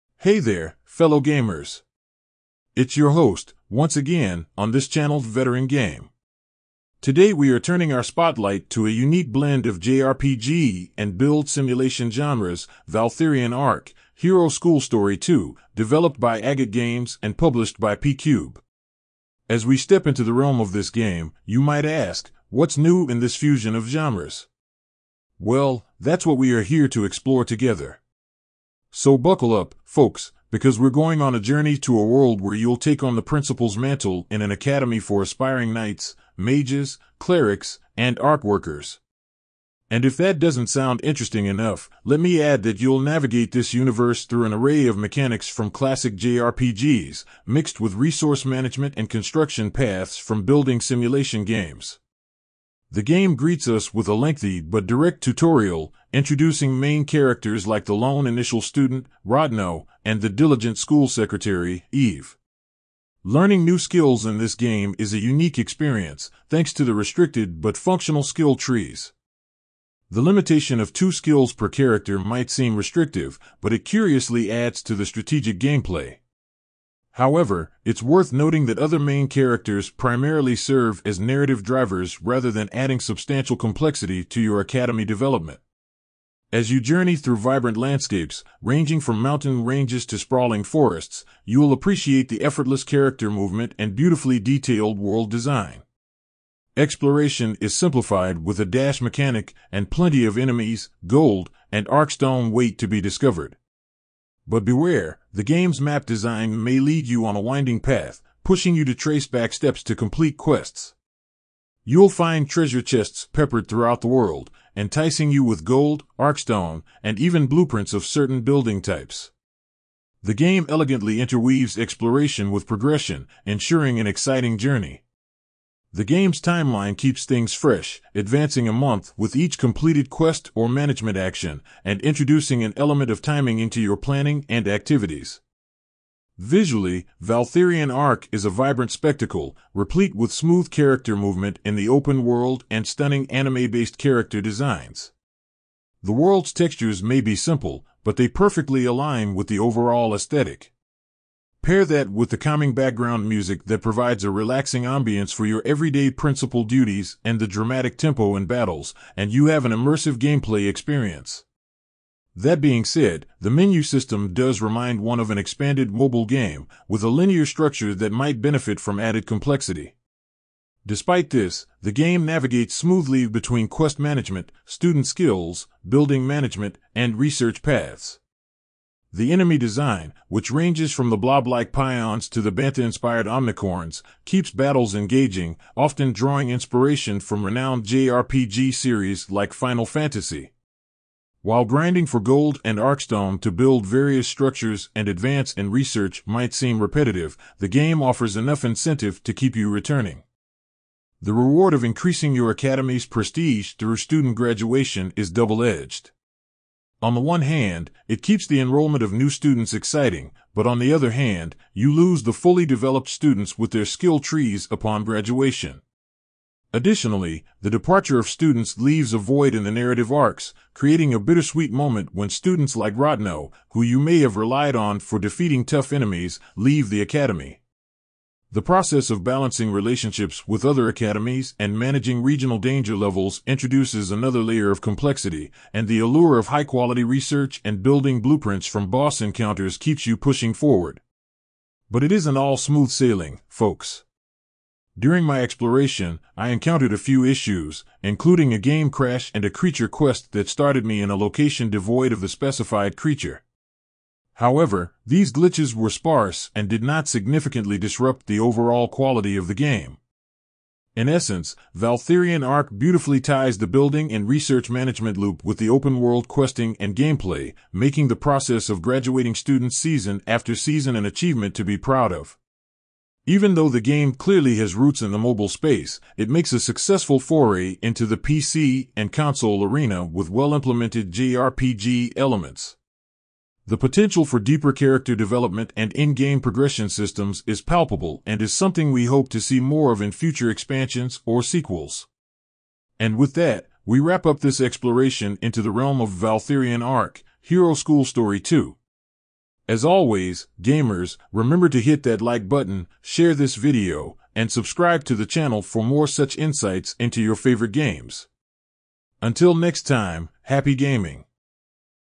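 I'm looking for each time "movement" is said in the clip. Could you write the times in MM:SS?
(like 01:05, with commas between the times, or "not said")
01:33, 02:21.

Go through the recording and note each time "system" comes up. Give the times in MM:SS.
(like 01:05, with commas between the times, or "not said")
02:43, 04:46.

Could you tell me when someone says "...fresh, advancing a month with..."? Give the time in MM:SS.
02:07.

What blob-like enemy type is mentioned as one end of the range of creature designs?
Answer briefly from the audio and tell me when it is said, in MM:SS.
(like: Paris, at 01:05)
pions, at 03:01.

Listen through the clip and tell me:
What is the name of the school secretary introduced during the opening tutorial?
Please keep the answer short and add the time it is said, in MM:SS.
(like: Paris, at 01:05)
Eve, at 01:01.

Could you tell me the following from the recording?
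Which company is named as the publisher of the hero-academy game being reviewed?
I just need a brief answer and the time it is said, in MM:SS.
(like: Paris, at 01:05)
P-Cube, at 00:17.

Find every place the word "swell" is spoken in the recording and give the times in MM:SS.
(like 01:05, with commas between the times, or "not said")
not said.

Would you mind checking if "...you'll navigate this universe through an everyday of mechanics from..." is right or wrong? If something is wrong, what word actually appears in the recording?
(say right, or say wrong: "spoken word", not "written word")
wrong: "array", not "everyday".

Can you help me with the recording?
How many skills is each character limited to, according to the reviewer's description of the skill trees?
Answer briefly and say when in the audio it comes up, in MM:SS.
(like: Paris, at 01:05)
2, at 01:10.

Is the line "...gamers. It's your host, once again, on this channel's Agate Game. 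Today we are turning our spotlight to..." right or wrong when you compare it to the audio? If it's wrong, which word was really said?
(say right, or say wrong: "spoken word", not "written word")
wrong: "Veteran", not "Agate".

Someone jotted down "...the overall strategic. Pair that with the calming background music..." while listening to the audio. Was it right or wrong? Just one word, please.
wrong.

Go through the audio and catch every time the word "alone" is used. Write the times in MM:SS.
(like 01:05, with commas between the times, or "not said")
not said.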